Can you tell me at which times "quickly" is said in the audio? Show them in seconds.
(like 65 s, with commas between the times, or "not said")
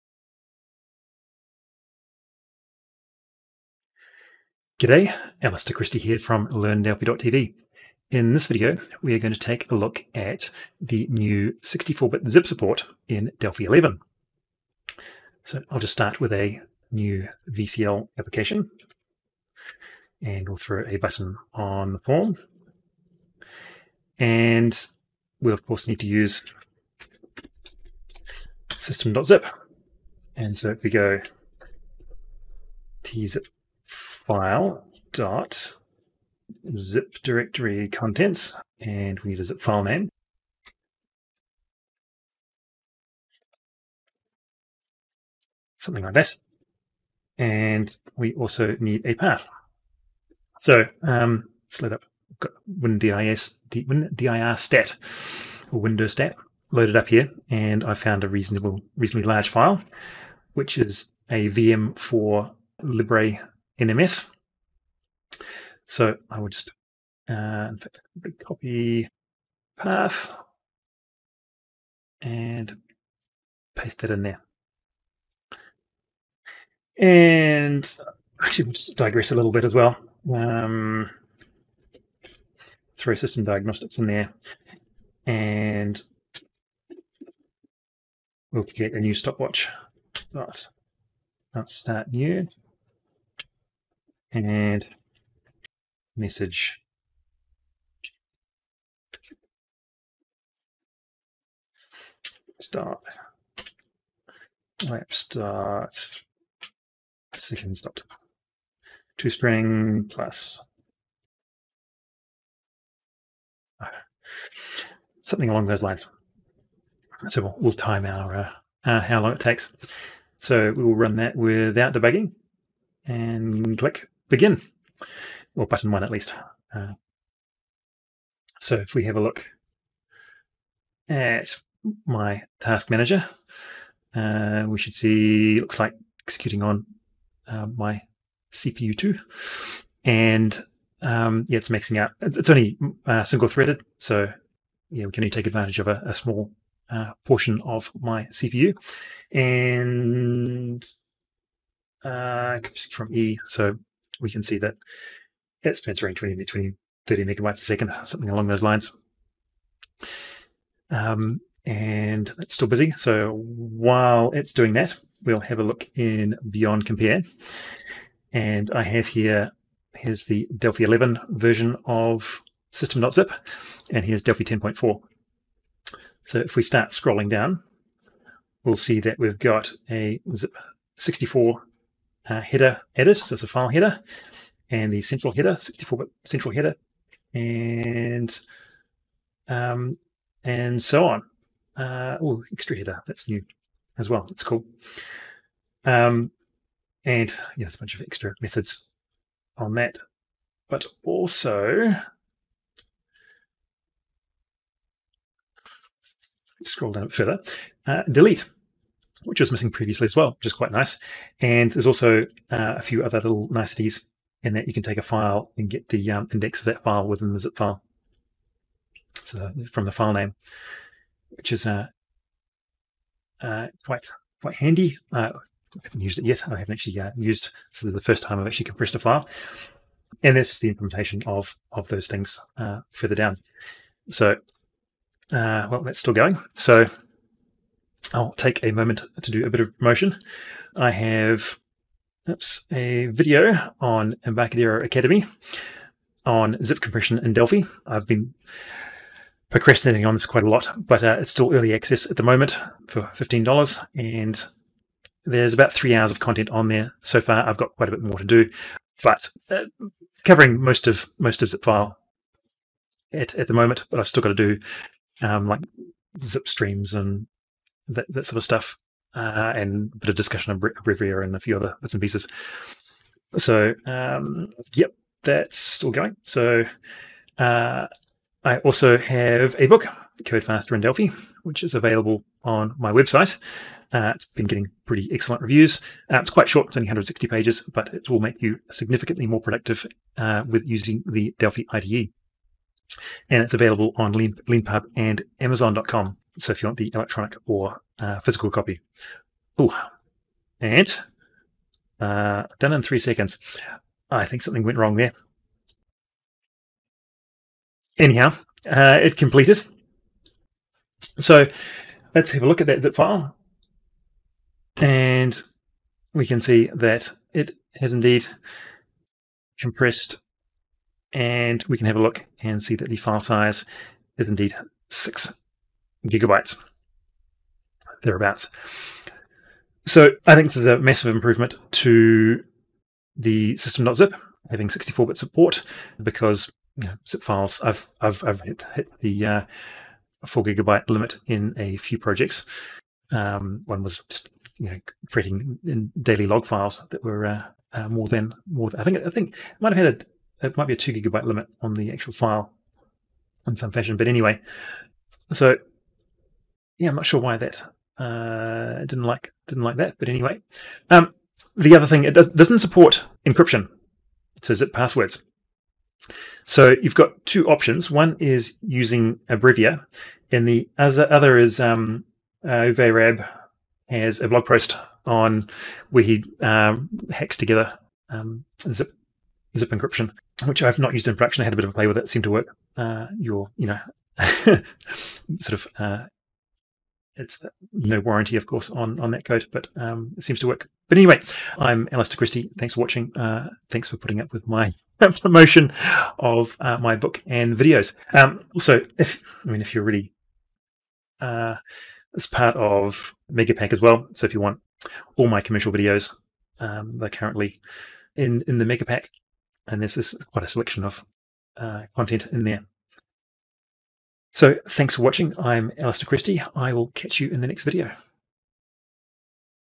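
not said.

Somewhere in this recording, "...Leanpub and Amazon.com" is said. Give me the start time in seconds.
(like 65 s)
294 s.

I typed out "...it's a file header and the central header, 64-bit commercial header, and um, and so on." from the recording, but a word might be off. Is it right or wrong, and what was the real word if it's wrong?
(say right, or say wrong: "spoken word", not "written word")
wrong: "central", not "commercial".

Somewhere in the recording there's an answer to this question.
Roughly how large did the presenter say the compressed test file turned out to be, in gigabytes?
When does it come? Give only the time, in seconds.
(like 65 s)
324 s.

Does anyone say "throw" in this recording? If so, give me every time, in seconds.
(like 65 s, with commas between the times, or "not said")
20 s, 82 s.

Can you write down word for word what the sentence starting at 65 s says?
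So I will just uh, copy path and paste that in there.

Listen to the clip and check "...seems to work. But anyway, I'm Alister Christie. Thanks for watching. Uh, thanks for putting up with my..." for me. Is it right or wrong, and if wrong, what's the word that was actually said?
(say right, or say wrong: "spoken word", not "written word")
right.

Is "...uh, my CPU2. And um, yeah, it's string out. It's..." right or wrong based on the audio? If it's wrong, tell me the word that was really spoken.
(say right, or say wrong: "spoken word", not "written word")
wrong: "maxing", not "string".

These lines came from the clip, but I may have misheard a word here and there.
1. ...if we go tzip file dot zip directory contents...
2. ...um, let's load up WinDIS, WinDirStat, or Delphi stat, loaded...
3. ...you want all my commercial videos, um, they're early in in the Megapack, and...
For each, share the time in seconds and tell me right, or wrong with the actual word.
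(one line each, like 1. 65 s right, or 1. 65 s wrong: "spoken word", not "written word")
1. 30 s right
2. 51 s wrong: "Windows", not "Delphi"
3. 404 s wrong: "currently", not "early".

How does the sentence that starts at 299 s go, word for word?
Oh, and uh, done in three seconds.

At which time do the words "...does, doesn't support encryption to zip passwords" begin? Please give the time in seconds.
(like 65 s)
362 s.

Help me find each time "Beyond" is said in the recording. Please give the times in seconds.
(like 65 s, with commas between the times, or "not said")
166 s.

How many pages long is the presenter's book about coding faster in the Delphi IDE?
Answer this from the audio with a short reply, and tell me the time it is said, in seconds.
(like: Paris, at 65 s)
160, at 286 s.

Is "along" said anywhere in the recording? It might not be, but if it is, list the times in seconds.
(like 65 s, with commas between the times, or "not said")
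115 s, 158 s.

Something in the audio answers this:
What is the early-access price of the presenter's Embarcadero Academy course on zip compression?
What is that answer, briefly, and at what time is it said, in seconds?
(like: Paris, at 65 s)
$15, at 253 s.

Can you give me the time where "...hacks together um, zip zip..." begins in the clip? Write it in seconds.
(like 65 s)
377 s.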